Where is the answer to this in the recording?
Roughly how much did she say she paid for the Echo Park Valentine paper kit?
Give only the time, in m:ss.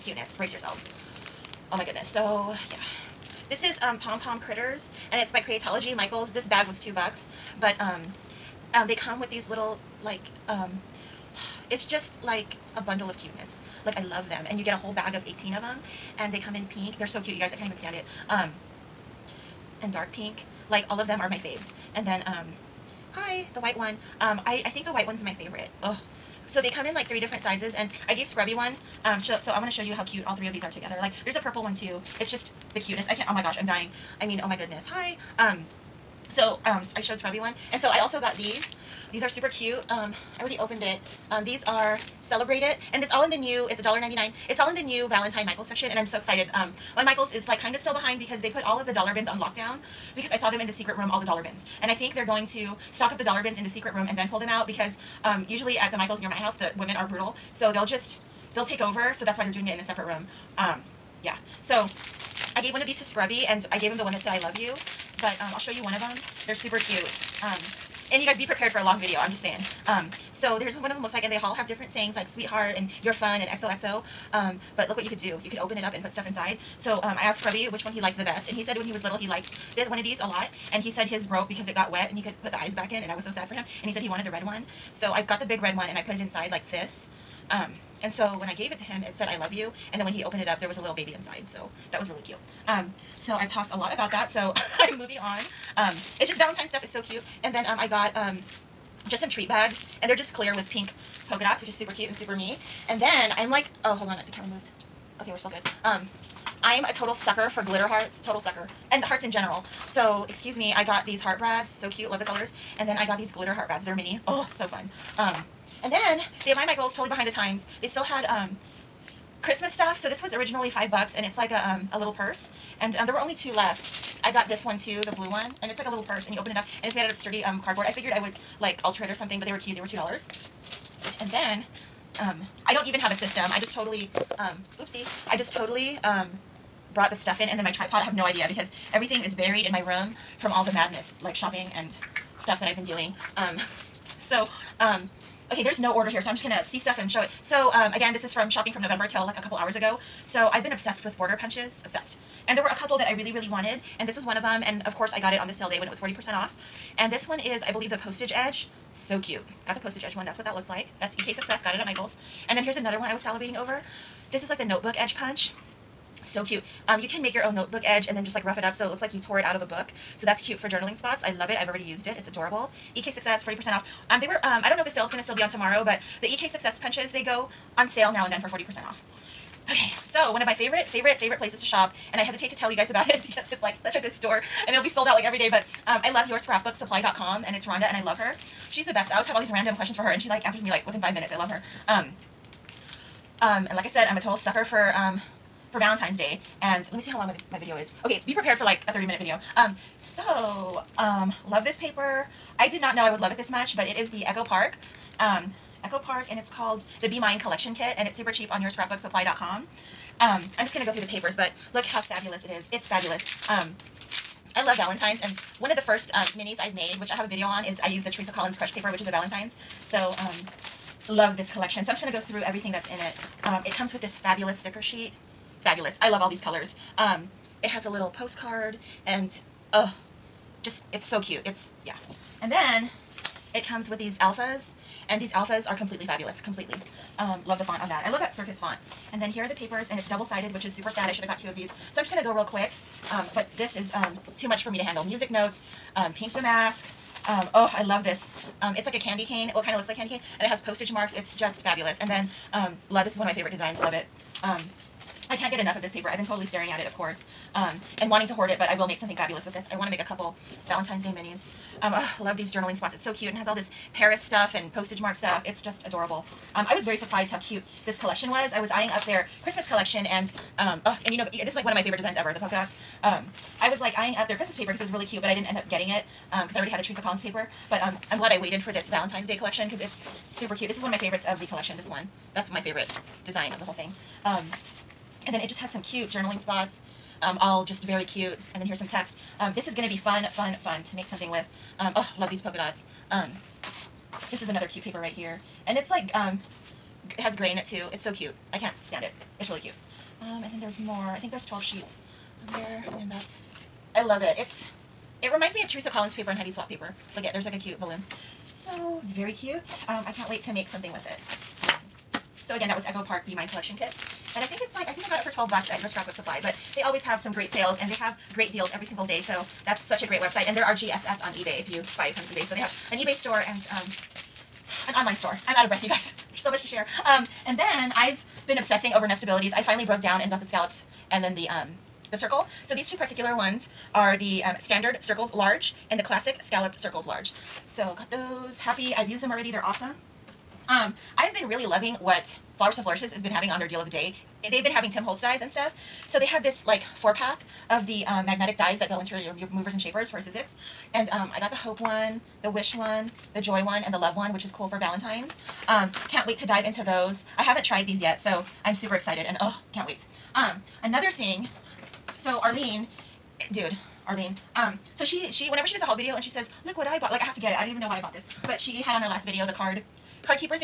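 5:15.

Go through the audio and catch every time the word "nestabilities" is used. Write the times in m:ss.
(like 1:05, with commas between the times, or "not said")
5:29.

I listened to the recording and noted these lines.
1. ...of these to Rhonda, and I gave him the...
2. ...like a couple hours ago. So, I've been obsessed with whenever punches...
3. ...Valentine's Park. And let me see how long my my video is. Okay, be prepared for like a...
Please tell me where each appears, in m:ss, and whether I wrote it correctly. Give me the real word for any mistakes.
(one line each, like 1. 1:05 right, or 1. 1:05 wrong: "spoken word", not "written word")
1. 1:02 wrong: "Scrubby", not "Rhonda"
2. 2:29 wrong: "border", not "whenever"
3. 3:15 wrong: "Day", not "Park".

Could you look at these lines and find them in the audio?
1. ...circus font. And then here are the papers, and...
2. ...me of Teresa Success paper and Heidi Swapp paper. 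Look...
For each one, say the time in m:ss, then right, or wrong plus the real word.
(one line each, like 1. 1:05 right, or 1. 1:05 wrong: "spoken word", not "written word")
1. 3:58 right
2. 5:05 wrong: "Collins", not "Success".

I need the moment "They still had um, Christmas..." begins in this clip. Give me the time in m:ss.
1:57.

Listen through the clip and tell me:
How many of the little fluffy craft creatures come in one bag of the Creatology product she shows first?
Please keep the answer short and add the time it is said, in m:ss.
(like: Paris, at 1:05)
18, at 0:15.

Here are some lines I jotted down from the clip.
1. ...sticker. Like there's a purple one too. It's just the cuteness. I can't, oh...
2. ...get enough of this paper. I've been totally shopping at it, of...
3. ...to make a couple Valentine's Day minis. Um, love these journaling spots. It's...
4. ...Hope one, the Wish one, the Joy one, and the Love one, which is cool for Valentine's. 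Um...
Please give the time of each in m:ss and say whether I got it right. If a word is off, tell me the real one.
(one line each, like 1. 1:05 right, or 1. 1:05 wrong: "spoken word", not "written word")
1. 0:30 wrong: "together", not "sticker"
2. 4:15 wrong: "staring", not "shopping"
3. 4:19 right
4. 5:51 right.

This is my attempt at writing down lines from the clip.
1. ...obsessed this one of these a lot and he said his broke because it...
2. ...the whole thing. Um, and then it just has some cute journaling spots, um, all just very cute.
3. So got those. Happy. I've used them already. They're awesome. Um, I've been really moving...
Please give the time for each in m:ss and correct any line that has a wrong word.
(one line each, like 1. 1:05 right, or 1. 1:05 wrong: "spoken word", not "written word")
1. 1:19 wrong: "liked", not "obsessed"
2. 4:43 right
3. 5:37 wrong: "loving", not "moving".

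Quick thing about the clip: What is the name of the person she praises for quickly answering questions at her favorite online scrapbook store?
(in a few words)
Rhonda.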